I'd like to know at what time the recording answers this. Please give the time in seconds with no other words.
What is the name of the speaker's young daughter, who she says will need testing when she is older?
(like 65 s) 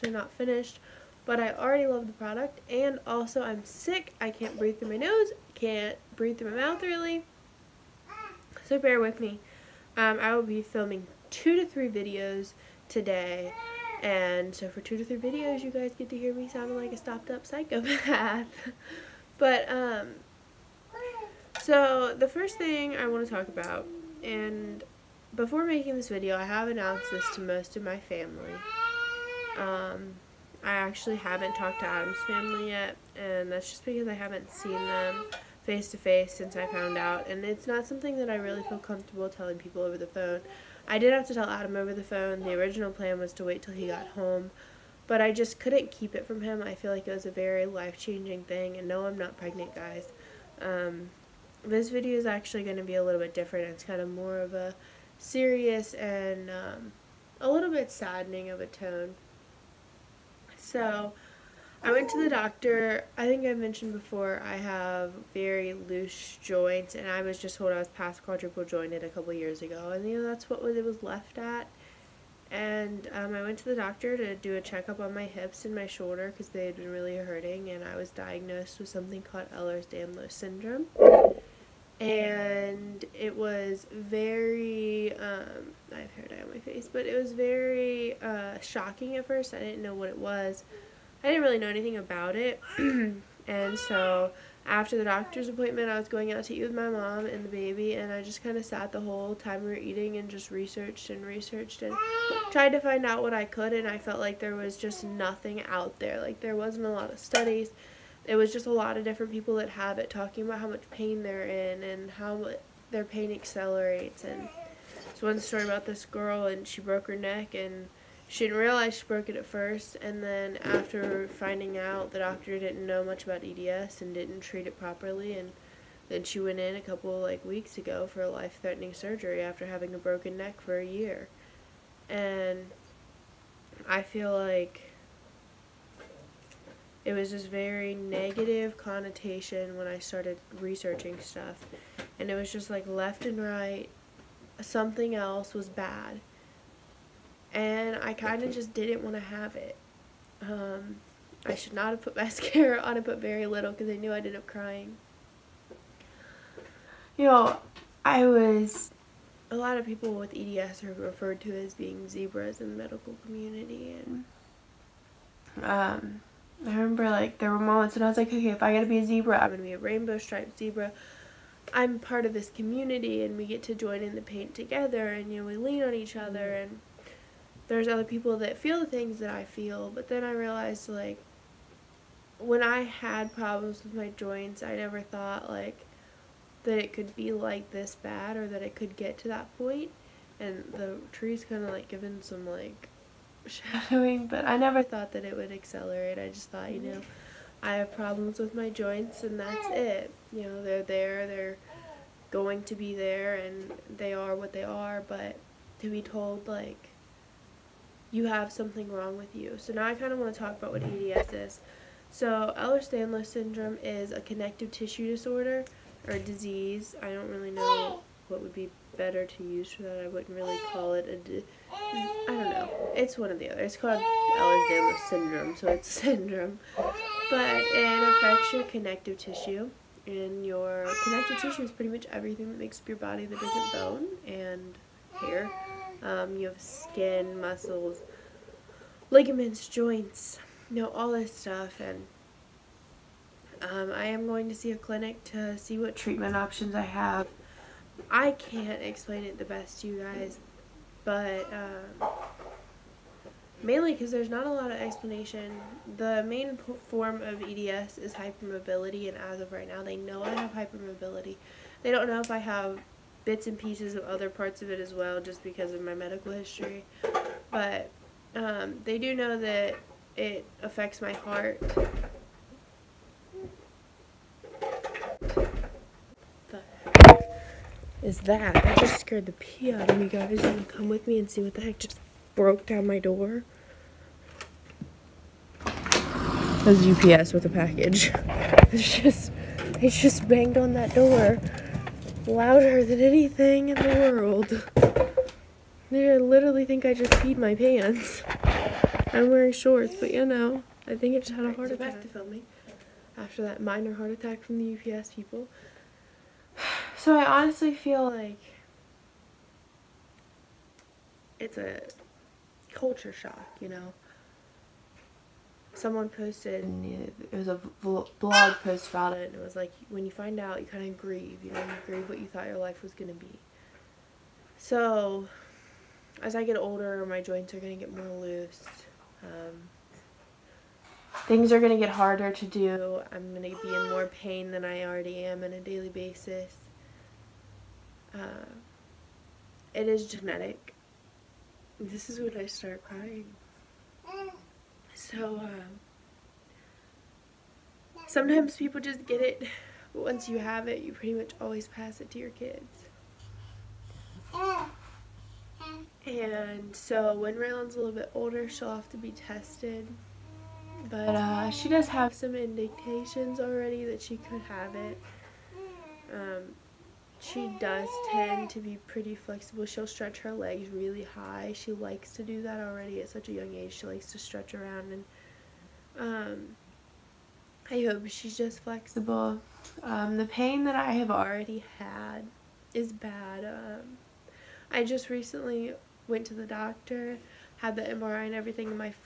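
357 s.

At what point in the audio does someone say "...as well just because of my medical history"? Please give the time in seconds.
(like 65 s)
264 s.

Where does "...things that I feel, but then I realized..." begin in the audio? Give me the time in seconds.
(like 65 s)
178 s.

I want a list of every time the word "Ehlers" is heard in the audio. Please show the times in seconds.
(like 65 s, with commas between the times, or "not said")
79 s, 212 s, 224 s.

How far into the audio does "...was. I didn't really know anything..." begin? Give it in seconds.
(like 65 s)
90 s.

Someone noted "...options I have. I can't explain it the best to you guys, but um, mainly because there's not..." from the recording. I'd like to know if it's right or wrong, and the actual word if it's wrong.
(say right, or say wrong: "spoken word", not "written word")
right.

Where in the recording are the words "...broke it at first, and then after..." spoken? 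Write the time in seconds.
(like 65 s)
119 s.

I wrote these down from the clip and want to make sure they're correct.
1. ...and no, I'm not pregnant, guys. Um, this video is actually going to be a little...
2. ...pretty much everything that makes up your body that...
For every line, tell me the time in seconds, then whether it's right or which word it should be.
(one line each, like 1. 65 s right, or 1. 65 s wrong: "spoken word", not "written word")
1. 48 s right
2. 231 s right.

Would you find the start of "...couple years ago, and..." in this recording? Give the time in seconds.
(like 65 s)
69 s.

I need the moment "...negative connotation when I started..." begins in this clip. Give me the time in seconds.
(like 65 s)
137 s.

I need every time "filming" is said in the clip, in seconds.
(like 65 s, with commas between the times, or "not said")
10 s, 302 s.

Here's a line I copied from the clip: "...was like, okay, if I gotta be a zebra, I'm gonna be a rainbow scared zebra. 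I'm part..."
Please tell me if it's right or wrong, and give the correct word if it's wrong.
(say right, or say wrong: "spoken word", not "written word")
wrong: "striped", not "scared".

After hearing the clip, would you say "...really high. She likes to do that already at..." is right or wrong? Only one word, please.
right.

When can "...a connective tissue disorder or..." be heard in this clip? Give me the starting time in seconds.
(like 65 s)
214 s.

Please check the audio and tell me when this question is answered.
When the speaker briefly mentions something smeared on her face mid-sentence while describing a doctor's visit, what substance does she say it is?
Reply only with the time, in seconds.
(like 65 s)
86 s.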